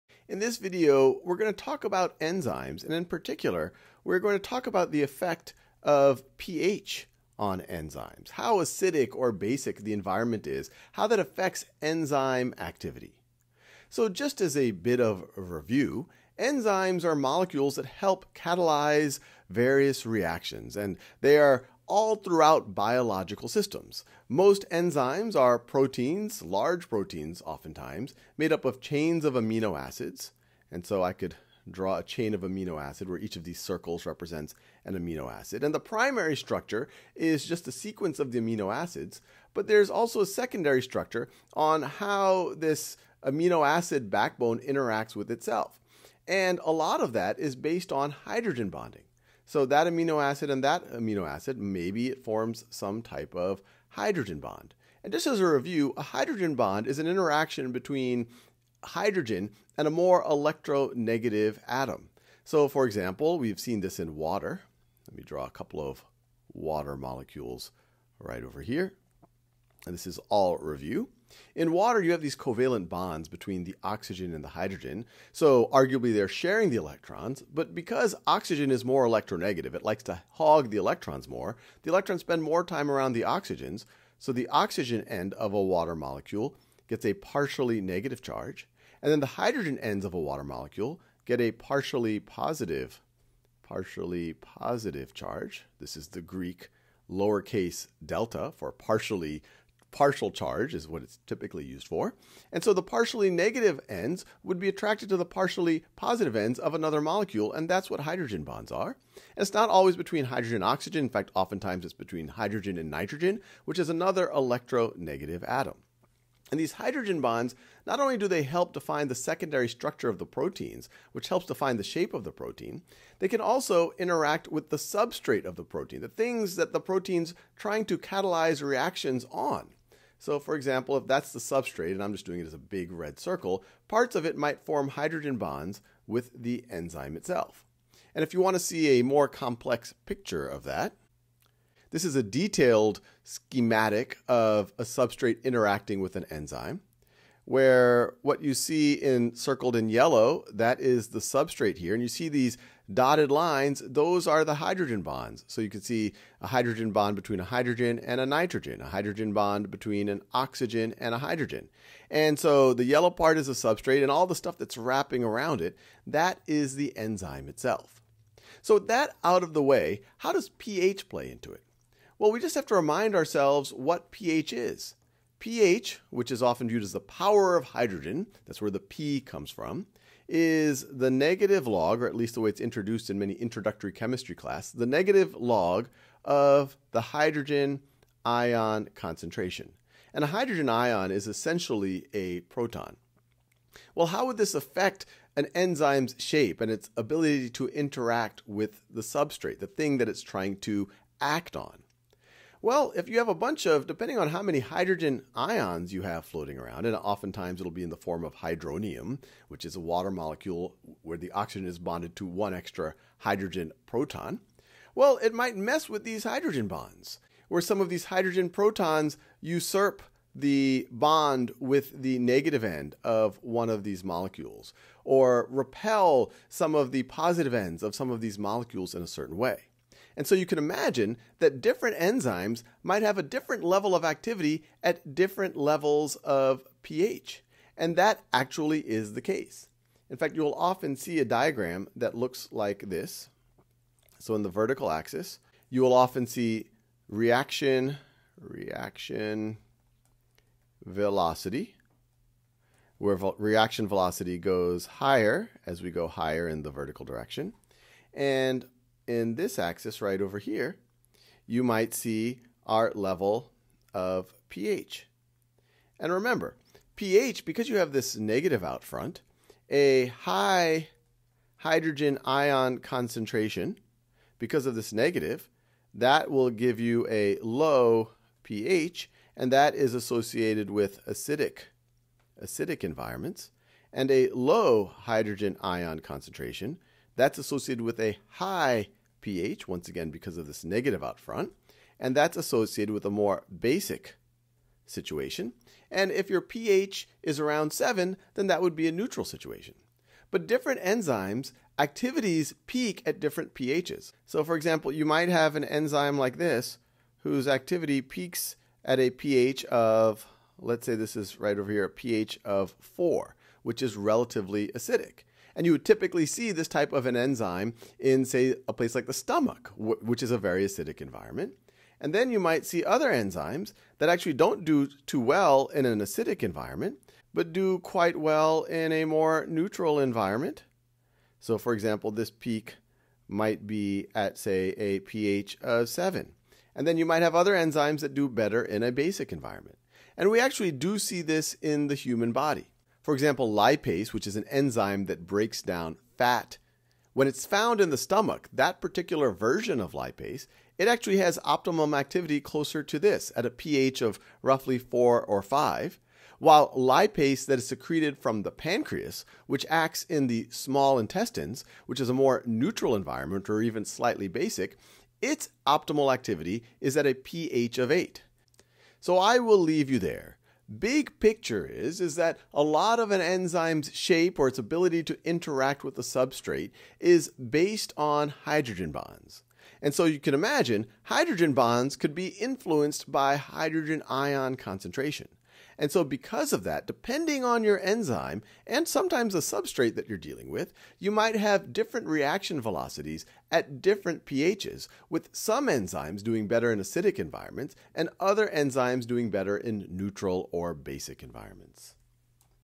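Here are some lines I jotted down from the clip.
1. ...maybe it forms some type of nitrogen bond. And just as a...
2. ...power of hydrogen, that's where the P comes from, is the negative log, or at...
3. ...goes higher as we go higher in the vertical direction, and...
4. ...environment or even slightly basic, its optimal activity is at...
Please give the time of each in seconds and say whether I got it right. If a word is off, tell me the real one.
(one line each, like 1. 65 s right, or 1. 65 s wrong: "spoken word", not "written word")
1. 51 s wrong: "hydrogen", not "nitrogen"
2. 177 s right
3. 254 s right
4. 362 s right.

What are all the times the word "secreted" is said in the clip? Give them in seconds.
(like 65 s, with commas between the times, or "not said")
357 s.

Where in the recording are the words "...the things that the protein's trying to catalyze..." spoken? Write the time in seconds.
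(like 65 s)
126 s.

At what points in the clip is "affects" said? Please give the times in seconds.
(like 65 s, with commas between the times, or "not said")
11 s, 194 s.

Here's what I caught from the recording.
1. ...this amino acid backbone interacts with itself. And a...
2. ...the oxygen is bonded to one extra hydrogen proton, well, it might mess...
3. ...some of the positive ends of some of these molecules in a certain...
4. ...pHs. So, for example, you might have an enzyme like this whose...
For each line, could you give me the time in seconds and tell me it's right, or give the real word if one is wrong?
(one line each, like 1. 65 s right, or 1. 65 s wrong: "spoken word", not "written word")
1. 42 s right
2. 211 s right
3. 226 s right
4. 303 s right.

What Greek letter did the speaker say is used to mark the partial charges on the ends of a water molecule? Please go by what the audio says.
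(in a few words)
lowercase delta.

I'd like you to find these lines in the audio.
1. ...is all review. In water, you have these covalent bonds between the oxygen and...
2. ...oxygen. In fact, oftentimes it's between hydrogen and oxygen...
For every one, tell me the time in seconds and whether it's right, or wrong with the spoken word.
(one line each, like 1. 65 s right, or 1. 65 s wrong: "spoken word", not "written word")
1. 70 s right
2. 110 s wrong: "nitrogen", not "oxygen".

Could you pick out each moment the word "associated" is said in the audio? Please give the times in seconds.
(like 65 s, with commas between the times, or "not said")
279 s, 287 s, 292 s.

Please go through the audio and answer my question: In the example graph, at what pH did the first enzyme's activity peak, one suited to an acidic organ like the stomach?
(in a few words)
4.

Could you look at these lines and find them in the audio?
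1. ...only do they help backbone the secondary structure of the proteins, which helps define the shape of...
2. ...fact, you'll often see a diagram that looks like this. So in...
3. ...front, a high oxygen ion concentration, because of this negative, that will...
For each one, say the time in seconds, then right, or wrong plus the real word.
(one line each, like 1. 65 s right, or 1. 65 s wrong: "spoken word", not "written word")
1. 118 s wrong: "define", not "backbone"
2. 240 s right
3. 268 s wrong: "hydrogen", not "oxygen".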